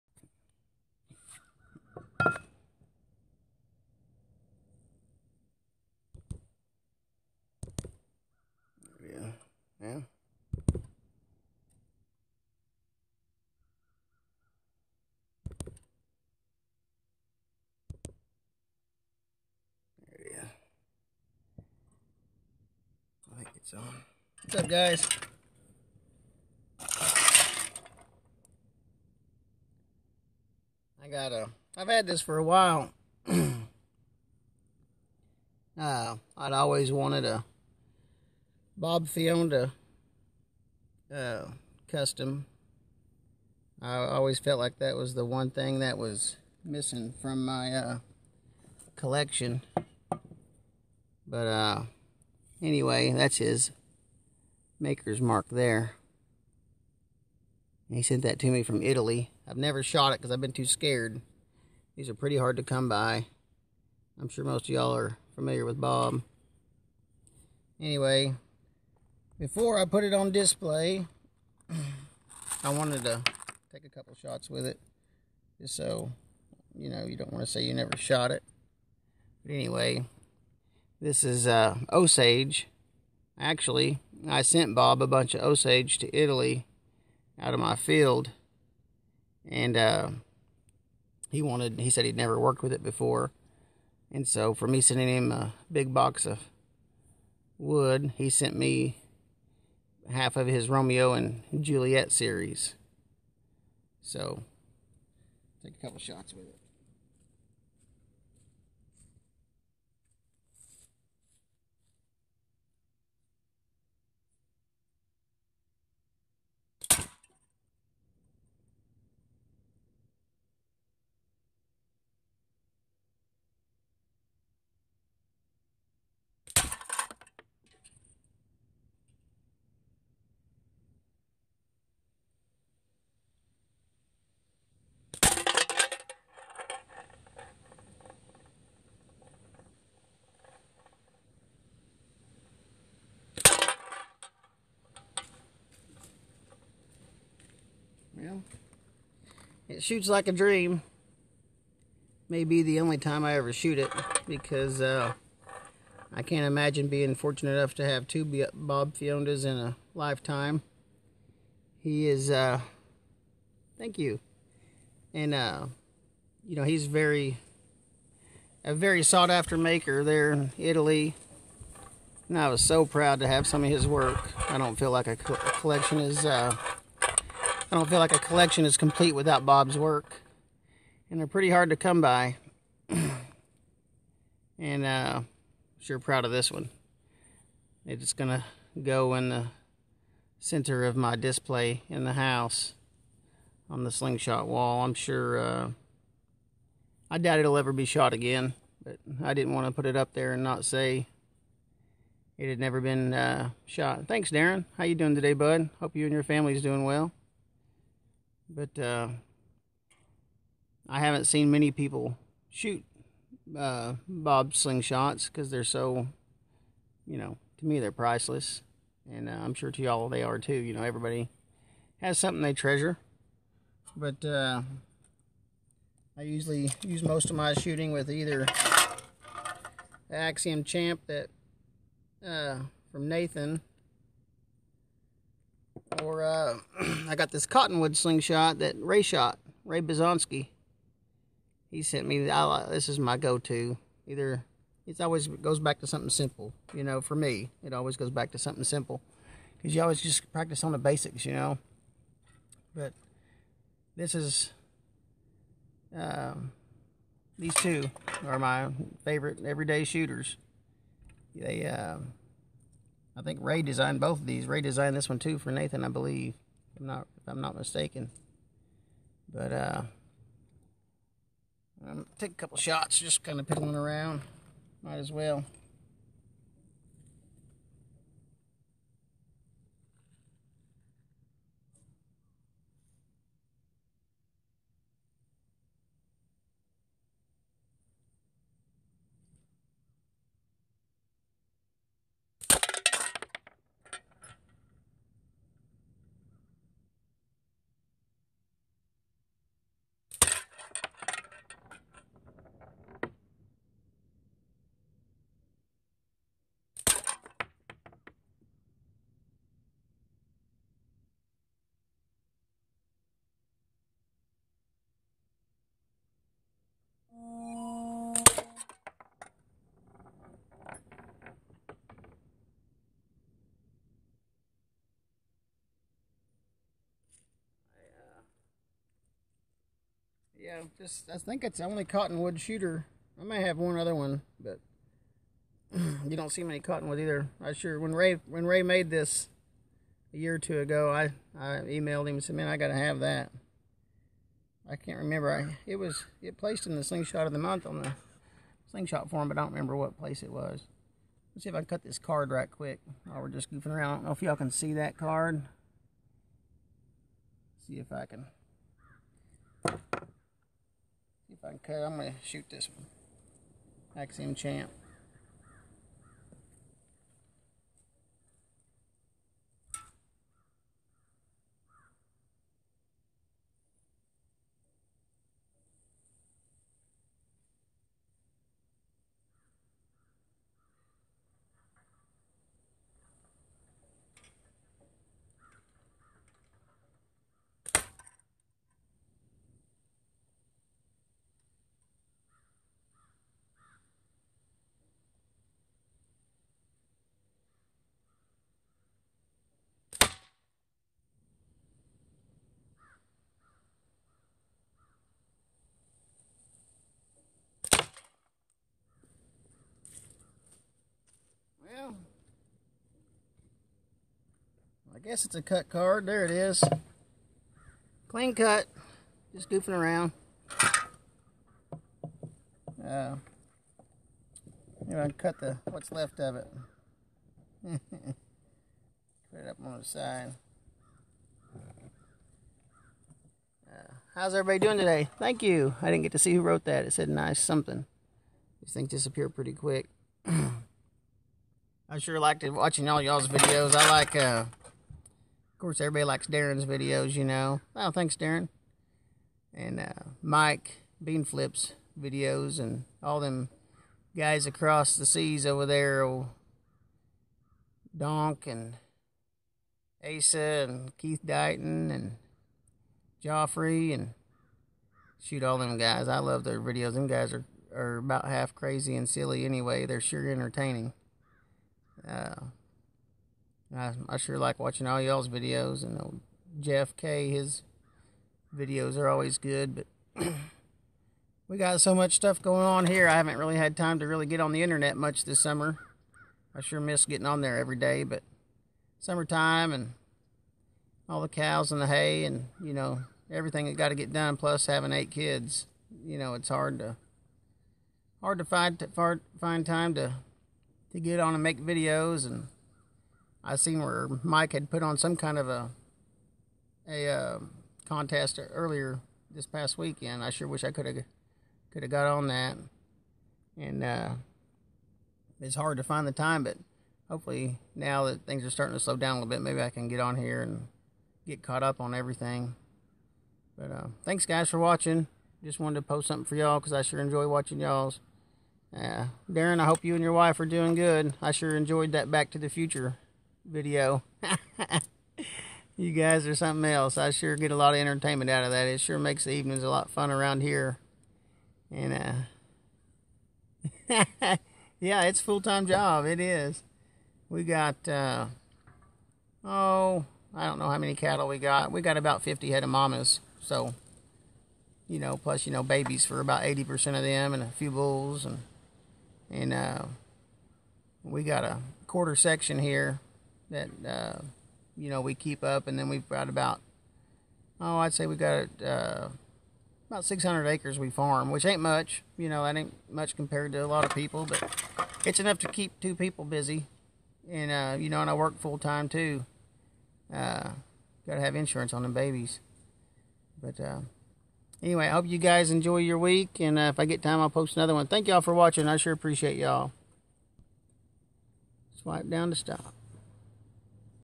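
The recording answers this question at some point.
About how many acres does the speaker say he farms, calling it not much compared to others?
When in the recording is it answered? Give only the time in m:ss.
9:30.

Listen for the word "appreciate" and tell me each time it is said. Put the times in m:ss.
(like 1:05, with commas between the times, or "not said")
9:48.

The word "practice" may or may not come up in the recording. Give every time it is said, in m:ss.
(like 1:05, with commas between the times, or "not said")
4:10.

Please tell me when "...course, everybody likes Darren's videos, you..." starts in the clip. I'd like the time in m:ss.
7:25.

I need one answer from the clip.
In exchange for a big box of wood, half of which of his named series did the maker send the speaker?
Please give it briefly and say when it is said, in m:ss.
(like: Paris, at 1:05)
Romeo and Juliet, at 1:40.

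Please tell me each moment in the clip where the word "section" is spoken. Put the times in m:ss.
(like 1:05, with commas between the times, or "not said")
9:22.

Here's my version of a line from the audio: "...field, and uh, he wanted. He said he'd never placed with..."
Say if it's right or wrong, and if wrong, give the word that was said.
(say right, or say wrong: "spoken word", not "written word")
wrong: "worked", not "placed".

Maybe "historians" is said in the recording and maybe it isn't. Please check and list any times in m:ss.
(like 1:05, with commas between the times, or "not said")
not said.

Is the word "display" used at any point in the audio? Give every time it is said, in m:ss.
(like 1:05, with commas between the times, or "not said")
1:10, 3:11.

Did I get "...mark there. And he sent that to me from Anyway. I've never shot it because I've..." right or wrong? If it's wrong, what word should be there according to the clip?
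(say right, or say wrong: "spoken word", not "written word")
wrong: "Italy", not "Anyway".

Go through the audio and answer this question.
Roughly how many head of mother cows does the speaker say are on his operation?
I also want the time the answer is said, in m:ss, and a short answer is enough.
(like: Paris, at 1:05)
50, at 9:12.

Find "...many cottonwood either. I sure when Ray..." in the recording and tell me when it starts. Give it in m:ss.
5:36.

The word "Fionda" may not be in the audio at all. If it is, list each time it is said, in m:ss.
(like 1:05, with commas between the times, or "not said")
0:39, 2:38.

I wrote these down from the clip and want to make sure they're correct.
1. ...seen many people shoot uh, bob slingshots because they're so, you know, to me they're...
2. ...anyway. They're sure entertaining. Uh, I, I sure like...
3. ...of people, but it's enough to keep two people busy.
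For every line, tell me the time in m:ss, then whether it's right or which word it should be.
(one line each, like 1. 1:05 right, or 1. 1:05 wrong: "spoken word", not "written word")
1. 3:31 right
2. 7:49 right
3. 9:33 right.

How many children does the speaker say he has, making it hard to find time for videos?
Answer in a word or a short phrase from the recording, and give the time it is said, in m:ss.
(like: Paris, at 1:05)
8, at 8:14.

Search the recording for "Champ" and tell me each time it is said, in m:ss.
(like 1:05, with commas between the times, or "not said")
3:50, 6:04.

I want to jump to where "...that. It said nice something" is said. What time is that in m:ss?
7:16.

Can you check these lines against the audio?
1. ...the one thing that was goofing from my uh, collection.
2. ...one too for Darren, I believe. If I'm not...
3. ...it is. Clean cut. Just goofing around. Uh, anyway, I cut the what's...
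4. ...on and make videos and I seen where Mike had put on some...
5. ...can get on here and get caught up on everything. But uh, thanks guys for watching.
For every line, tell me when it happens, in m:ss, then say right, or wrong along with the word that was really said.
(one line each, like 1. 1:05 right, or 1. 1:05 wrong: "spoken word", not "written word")
1. 0:45 wrong: "missing", not "goofing"
2. 4:25 wrong: "Nathan", not "Darren"
3. 6:56 right
4. 8:21 right
5. 8:39 right.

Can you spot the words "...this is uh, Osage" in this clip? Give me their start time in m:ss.
1:21.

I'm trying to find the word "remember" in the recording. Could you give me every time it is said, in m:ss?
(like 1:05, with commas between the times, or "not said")
5:44, 5:49.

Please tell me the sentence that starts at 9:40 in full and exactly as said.
Uh, got to have insurance on them babies.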